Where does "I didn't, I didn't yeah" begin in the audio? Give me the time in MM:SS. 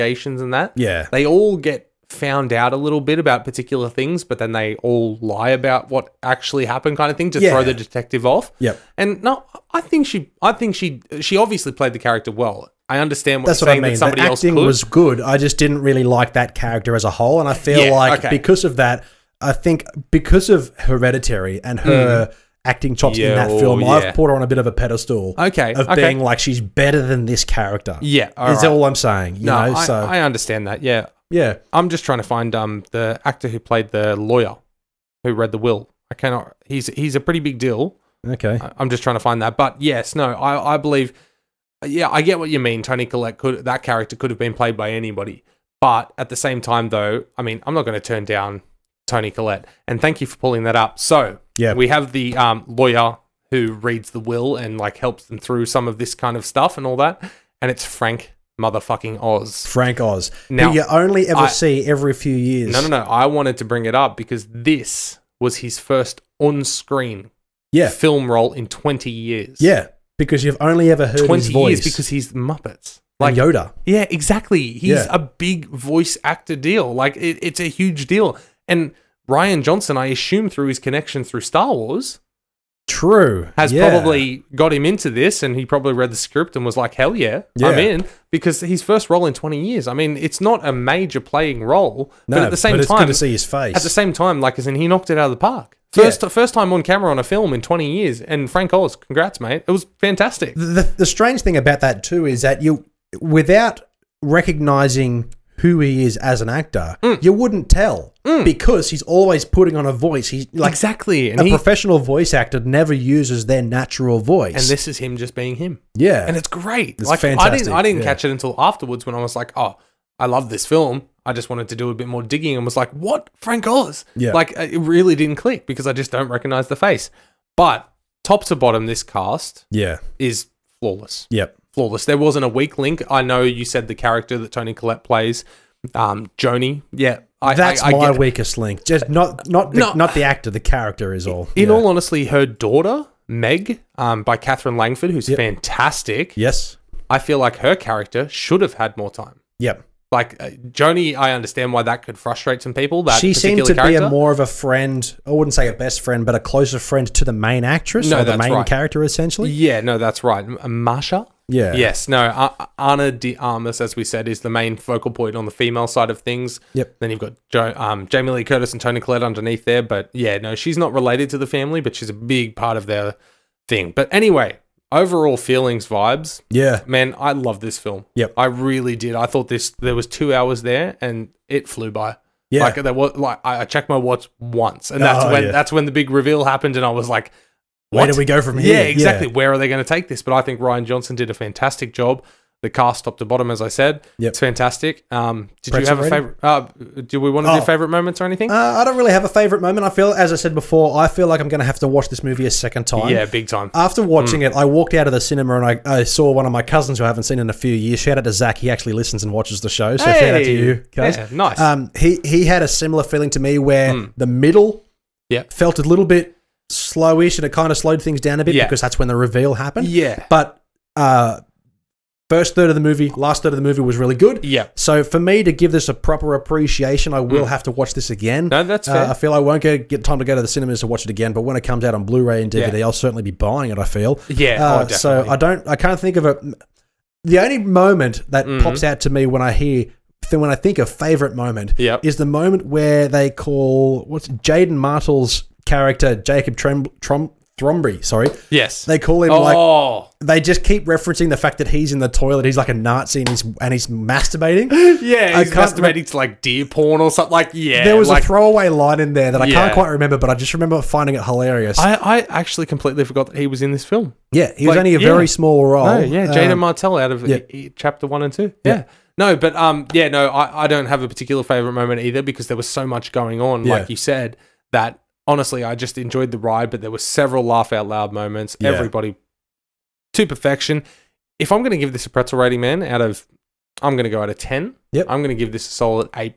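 01:57.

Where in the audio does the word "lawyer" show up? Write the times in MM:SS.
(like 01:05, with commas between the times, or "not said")
00:34, 00:52.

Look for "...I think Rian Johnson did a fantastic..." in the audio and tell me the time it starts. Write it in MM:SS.
03:10.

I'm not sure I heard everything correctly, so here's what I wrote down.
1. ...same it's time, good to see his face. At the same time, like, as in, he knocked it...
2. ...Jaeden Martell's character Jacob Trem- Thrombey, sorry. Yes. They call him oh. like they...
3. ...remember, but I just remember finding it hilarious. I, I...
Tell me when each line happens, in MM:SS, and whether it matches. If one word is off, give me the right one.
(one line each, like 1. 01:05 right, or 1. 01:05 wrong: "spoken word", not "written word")
1. 01:32 right
2. 04:04 right
3. 04:19 right.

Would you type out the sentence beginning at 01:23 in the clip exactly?
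probably got him into this and he probably read the script and was like, hell yeah, yeah, I'm in.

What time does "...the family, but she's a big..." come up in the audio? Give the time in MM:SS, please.
02:51.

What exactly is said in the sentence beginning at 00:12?
I understand what That's what I mean.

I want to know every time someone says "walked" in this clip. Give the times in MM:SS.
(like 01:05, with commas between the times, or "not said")
03:24.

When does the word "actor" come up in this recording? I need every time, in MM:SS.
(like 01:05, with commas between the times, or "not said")
00:33, 01:16, 01:46, 01:52, 02:20.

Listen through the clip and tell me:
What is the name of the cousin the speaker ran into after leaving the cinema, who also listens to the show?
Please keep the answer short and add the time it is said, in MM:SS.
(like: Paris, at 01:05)
Zach, at 03:28.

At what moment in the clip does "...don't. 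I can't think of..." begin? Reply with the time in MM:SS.
03:55.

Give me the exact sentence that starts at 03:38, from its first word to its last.
because that's when the reveal happened.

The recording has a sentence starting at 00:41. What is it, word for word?
Yeah, I get what you mean.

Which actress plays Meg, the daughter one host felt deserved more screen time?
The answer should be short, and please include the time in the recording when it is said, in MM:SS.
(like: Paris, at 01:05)
Katherine Langford, at 02:24.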